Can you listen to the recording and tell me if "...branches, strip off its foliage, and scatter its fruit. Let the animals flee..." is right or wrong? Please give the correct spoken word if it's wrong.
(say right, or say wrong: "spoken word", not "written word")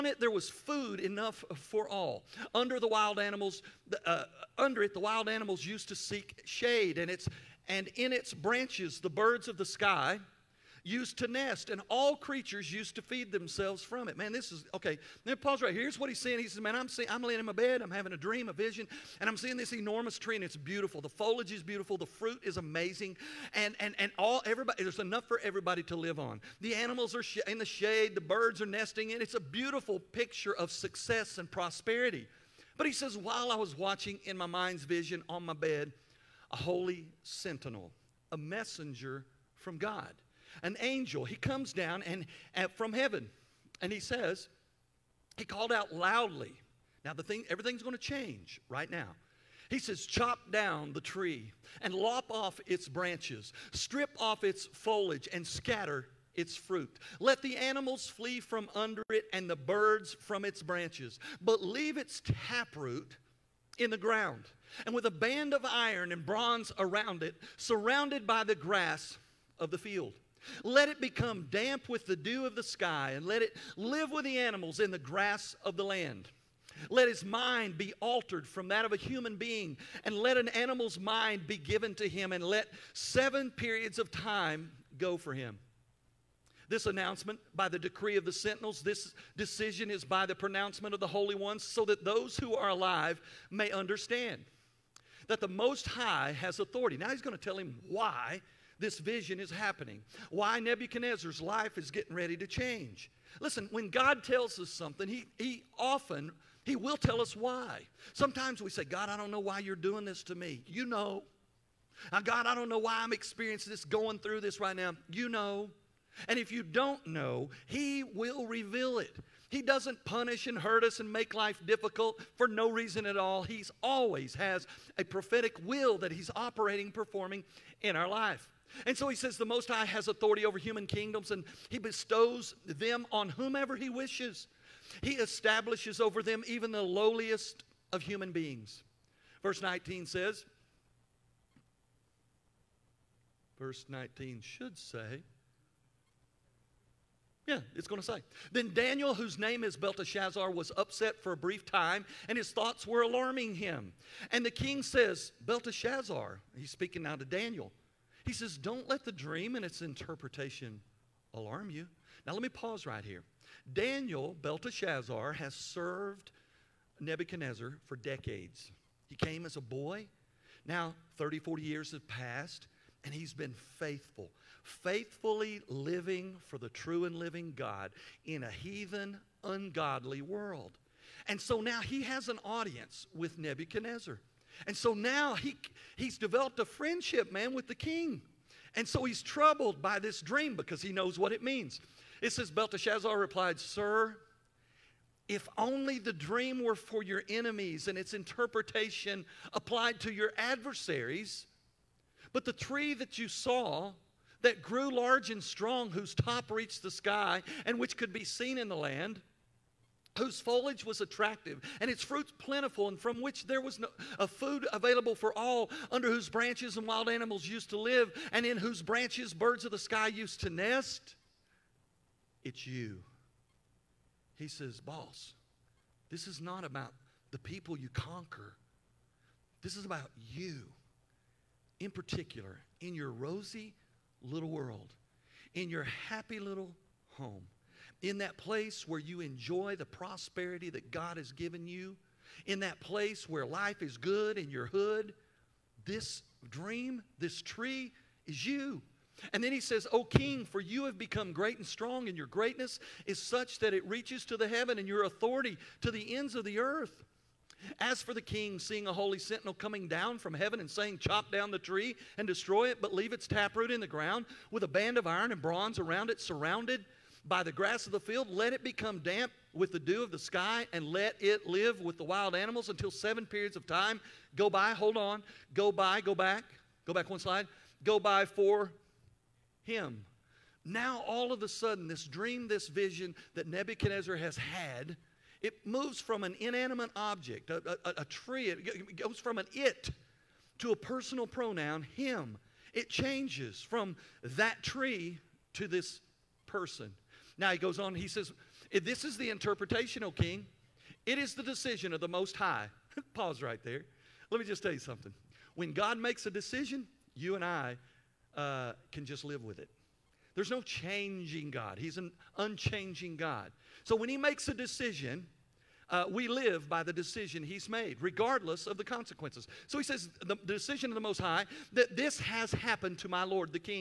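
right.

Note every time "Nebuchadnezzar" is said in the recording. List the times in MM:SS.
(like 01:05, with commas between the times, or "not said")
01:40, 02:46, 03:03, 04:43.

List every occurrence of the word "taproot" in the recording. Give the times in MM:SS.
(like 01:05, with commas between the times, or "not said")
01:02, 04:23.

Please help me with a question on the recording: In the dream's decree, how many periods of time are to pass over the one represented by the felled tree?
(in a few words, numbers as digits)
7.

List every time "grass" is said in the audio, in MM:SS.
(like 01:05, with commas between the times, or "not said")
01:08, 01:14, 04:27.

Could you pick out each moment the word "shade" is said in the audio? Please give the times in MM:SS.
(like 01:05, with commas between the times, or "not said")
00:06, 00:27.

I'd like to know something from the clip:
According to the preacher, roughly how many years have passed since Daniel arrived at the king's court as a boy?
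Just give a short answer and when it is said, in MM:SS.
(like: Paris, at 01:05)
30 to 40, at 02:51.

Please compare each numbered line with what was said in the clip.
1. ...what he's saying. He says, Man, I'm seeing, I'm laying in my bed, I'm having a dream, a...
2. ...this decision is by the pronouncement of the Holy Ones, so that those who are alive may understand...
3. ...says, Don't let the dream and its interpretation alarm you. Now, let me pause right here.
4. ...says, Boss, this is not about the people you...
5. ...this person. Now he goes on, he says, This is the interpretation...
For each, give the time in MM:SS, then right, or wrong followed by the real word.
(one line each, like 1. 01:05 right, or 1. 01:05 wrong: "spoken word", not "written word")
1. 00:15 right
2. 01:28 right
3. 02:38 right
4. 03:44 right
5. 04:55 right.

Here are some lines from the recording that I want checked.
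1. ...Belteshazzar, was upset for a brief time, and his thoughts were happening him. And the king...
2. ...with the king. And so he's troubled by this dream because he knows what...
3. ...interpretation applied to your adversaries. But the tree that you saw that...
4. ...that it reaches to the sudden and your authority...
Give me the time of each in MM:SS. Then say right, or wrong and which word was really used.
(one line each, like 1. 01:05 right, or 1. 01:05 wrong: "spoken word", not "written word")
1. 02:29 wrong: "alarming", not "happening"
2. 03:07 right
3. 03:18 right
4. 04:13 wrong: "heaven", not "sudden".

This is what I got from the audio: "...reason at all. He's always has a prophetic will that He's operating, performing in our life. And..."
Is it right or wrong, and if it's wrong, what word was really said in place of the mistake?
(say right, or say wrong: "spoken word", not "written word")
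right.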